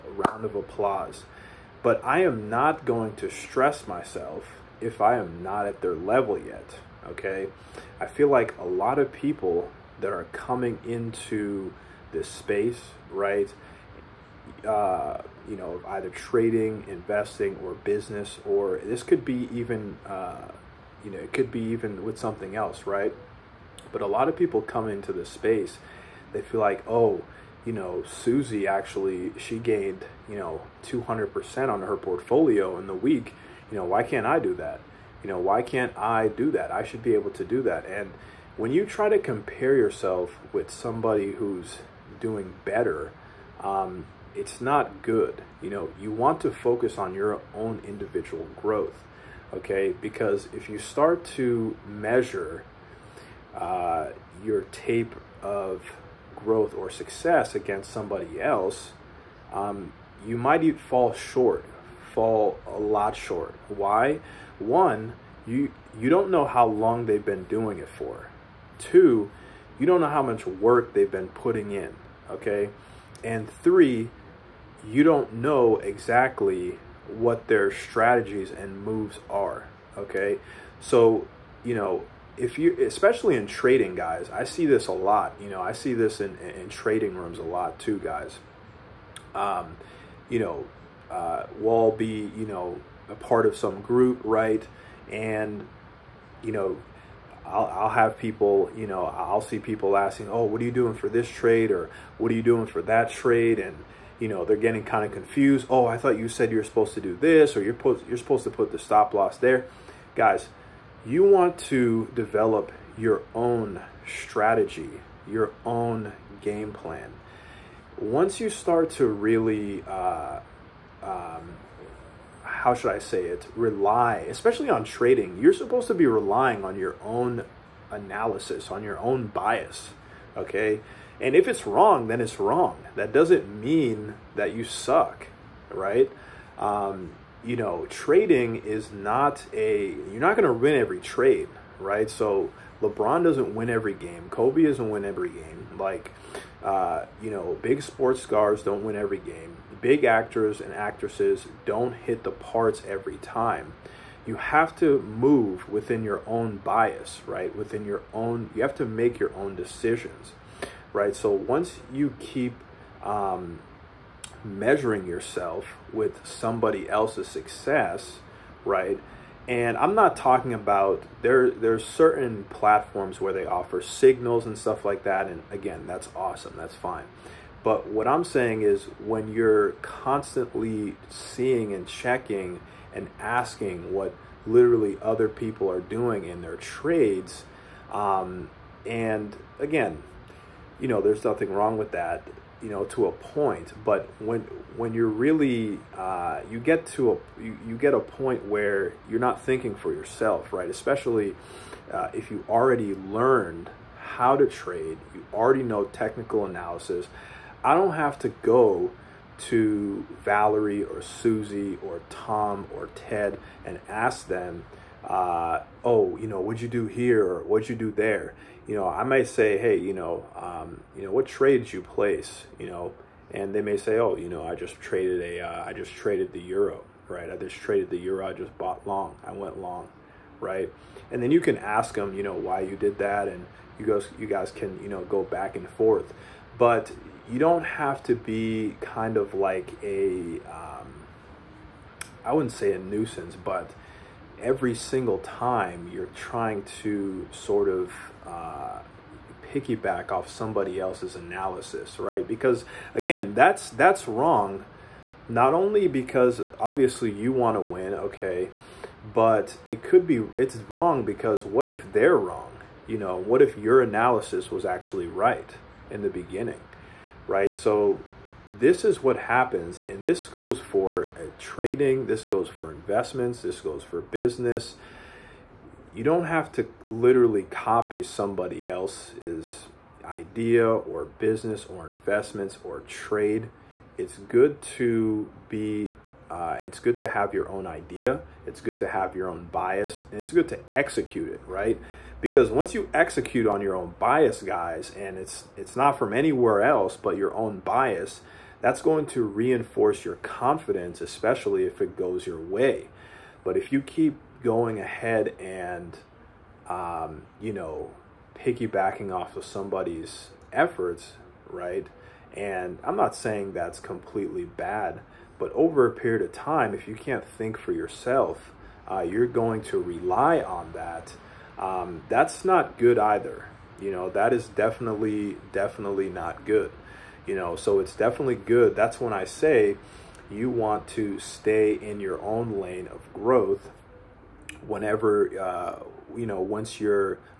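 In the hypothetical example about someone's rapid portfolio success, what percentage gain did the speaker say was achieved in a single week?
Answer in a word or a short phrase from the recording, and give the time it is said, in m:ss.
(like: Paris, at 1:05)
200%, at 0:30.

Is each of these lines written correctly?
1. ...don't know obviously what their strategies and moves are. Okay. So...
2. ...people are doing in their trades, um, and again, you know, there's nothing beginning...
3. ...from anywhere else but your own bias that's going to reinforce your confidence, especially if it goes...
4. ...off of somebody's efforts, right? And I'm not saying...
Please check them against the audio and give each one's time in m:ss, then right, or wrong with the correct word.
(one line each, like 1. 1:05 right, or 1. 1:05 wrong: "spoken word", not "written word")
1. 1:15 wrong: "exactly", not "obviously"
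2. 3:05 wrong: "wrong", not "beginning"
3. 4:55 right
4. 5:09 right.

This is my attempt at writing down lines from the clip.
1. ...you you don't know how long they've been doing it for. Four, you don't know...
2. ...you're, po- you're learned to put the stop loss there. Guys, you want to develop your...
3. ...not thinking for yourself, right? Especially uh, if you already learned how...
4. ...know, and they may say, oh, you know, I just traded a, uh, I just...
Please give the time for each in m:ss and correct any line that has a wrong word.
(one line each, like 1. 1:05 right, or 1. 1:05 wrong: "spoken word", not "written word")
1. 1:05 wrong: "Two", not "Four"
2. 1:47 wrong: "supposed", not "learned"
3. 3:19 right
4. 3:42 right.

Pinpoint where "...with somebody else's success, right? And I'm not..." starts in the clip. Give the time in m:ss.
2:45.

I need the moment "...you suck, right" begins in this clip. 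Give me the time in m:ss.
2:14.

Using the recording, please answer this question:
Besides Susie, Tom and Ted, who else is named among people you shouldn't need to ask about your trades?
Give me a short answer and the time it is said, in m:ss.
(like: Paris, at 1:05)
Valerie, at 3:30.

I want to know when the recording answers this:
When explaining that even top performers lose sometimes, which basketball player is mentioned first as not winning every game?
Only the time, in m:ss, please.
2:22.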